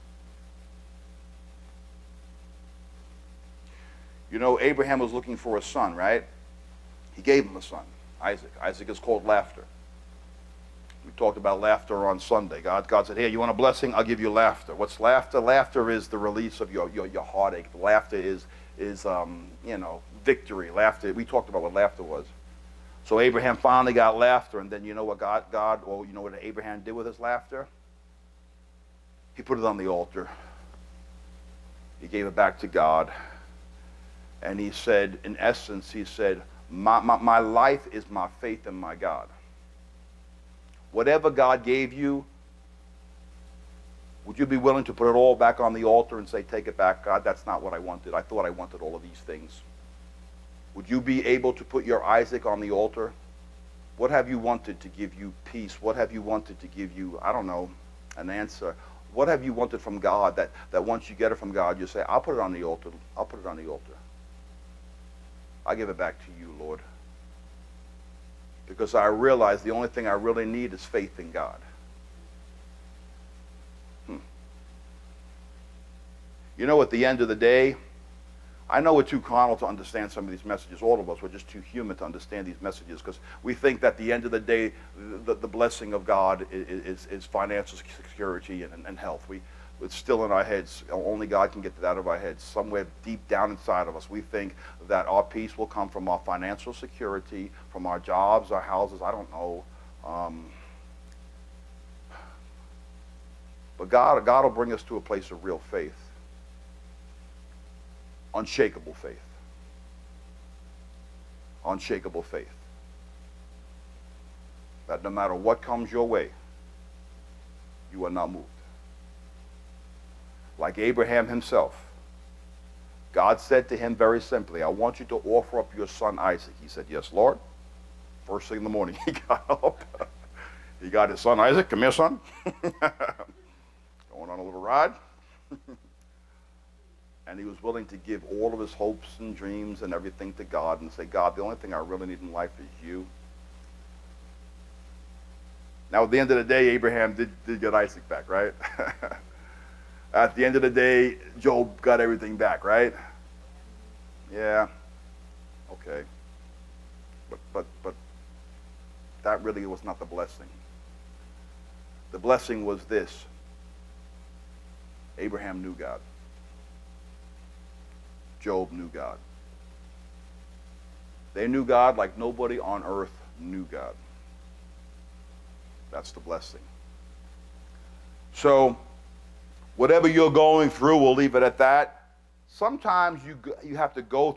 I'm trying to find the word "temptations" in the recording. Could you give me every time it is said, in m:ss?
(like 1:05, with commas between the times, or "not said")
not said.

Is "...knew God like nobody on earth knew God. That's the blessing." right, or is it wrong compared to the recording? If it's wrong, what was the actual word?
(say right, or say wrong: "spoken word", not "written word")
right.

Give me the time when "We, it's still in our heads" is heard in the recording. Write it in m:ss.
1:29.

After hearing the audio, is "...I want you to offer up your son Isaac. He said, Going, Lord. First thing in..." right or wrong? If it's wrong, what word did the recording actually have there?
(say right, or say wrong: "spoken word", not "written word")
wrong: "Yes", not "Going".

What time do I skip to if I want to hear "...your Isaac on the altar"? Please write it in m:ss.
0:51.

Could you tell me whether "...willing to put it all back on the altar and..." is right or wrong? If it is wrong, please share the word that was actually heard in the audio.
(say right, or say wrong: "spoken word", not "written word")
right.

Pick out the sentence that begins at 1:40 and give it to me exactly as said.
Um, but God, God will bring us to a place of real faith, unshakable faith.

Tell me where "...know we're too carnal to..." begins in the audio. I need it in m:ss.
1:18.